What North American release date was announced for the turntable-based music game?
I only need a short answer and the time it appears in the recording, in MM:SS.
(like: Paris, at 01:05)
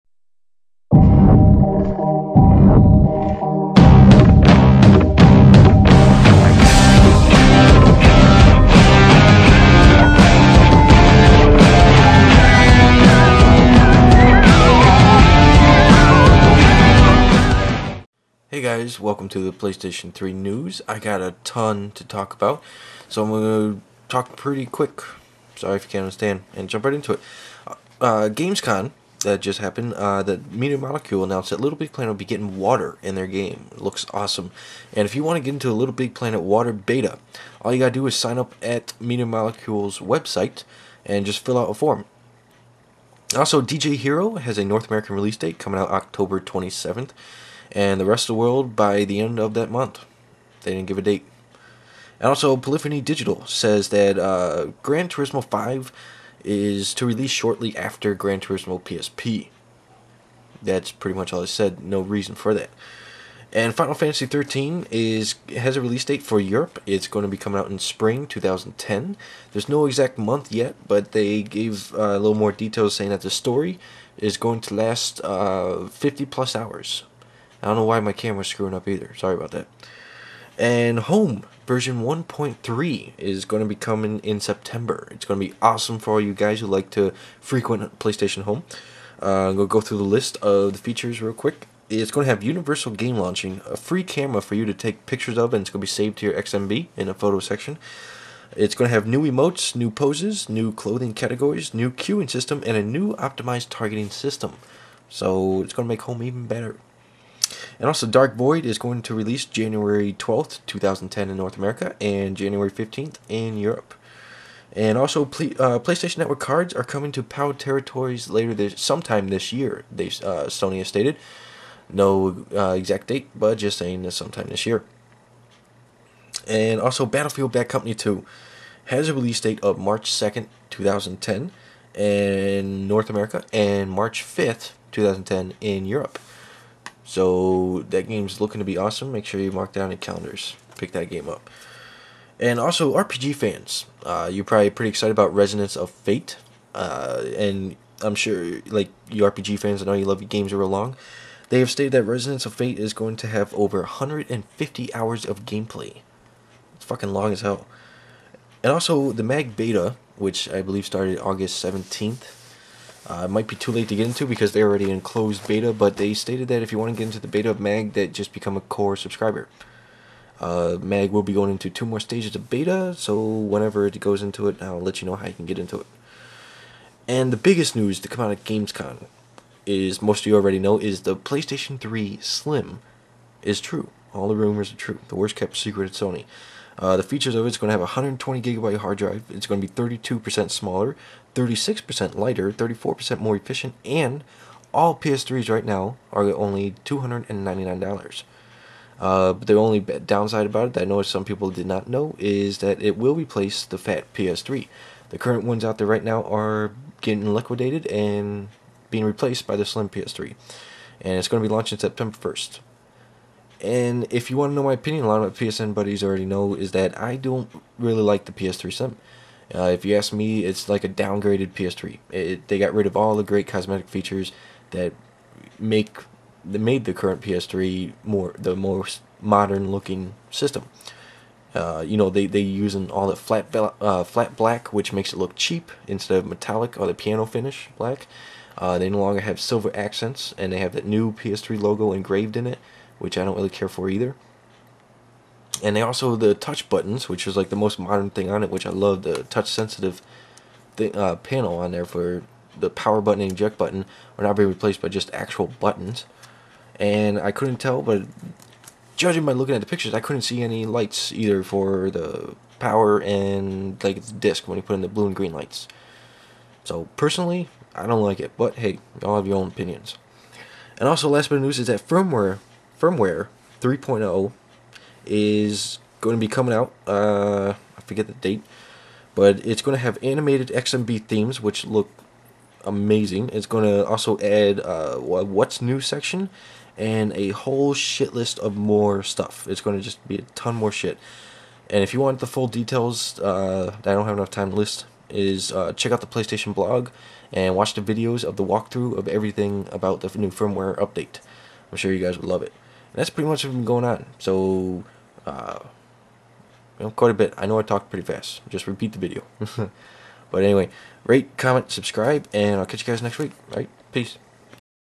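October 27th, at 00:45.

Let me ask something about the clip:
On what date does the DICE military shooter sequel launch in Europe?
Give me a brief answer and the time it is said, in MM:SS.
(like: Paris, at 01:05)
March 5th, 2010, at 02:13.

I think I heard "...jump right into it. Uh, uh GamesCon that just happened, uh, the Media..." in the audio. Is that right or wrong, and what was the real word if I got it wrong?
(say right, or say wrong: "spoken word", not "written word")
right.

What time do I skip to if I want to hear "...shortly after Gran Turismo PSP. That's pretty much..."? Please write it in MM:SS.
00:57.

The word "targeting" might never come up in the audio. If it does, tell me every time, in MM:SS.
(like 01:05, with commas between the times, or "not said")
01:43.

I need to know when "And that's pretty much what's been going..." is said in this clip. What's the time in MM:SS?
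05:02.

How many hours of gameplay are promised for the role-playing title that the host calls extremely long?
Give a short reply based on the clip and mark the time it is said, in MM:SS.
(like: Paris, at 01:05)
150+ hours, at 02:33.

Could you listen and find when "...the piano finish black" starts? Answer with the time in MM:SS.
03:56.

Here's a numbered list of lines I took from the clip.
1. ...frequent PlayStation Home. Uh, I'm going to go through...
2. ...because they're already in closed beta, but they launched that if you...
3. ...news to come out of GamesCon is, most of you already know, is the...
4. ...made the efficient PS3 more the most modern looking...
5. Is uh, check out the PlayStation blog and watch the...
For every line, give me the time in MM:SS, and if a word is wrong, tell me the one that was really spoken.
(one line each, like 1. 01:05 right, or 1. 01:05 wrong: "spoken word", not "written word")
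1. 01:27 right
2. 02:44 wrong: "stated", not "launched"
3. 02:57 right
4. 03:46 wrong: "current", not "efficient"
5. 04:55 right.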